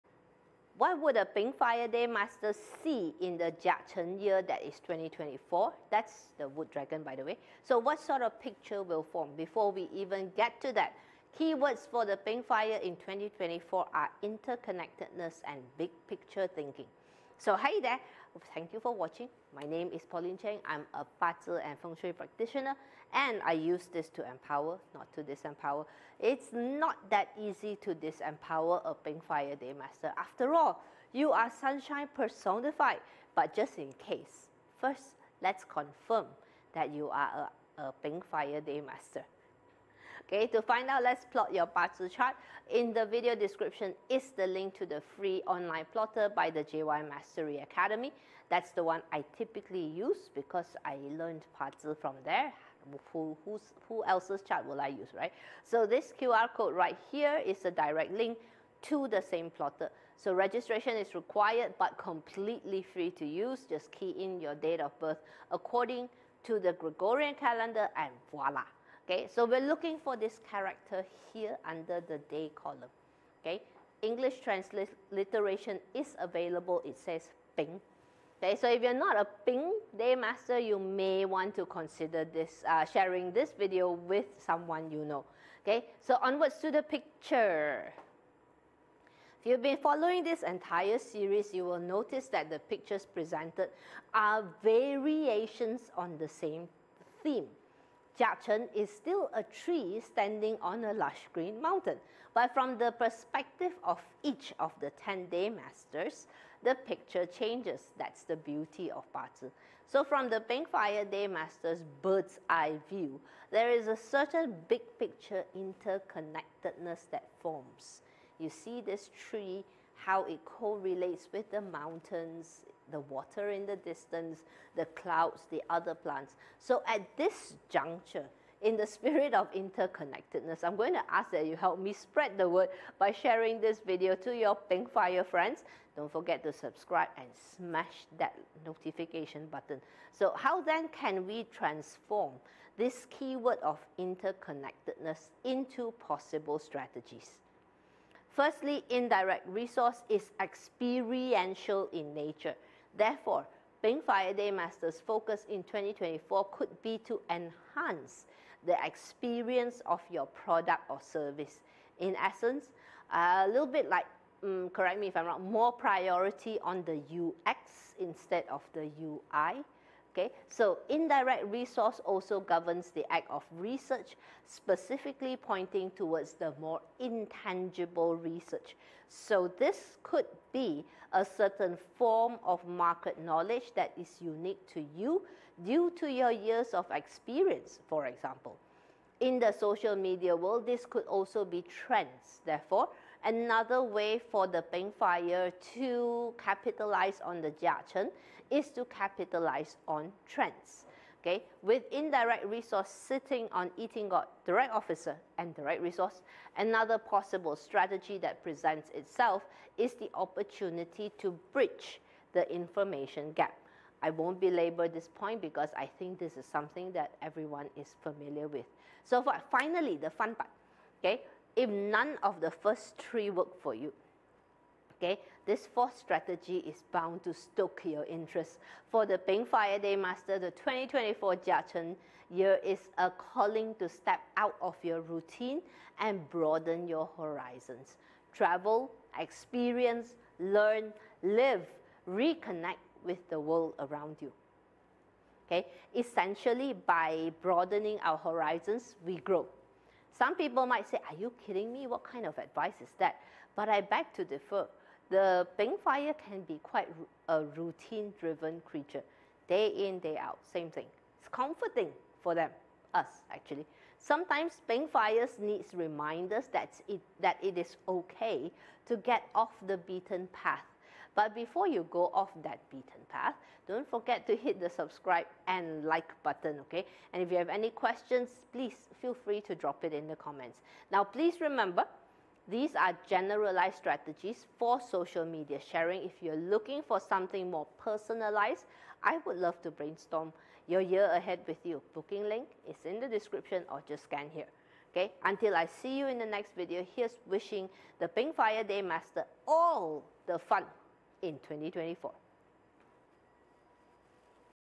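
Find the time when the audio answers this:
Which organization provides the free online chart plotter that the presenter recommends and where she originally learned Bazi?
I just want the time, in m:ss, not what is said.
0:46.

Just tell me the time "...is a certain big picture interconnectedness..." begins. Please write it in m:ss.
1:53.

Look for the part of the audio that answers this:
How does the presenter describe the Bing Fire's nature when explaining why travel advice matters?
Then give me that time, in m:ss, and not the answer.
4:17.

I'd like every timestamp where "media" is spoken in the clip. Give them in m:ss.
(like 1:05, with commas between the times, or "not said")
3:09, 4:45.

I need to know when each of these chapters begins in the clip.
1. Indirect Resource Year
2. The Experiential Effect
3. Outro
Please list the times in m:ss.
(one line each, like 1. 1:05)
1. 1:27
2. 2:28
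3. 3:42.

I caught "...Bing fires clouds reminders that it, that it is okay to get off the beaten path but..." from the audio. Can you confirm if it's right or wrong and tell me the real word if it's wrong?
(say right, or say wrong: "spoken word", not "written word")
wrong: "needs", not "clouds".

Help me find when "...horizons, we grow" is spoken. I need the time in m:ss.
4:08.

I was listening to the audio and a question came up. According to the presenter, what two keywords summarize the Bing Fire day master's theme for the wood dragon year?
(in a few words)
interconnectedness and big picture thinking.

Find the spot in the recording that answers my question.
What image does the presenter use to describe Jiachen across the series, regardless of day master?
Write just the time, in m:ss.
1:39.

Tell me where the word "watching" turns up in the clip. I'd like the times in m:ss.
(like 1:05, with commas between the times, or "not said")
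0:18.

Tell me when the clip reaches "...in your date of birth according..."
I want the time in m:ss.
1:04.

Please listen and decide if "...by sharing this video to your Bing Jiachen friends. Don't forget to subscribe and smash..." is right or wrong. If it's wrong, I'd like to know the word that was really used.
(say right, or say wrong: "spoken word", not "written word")
wrong: "Fire", not "Jiachen".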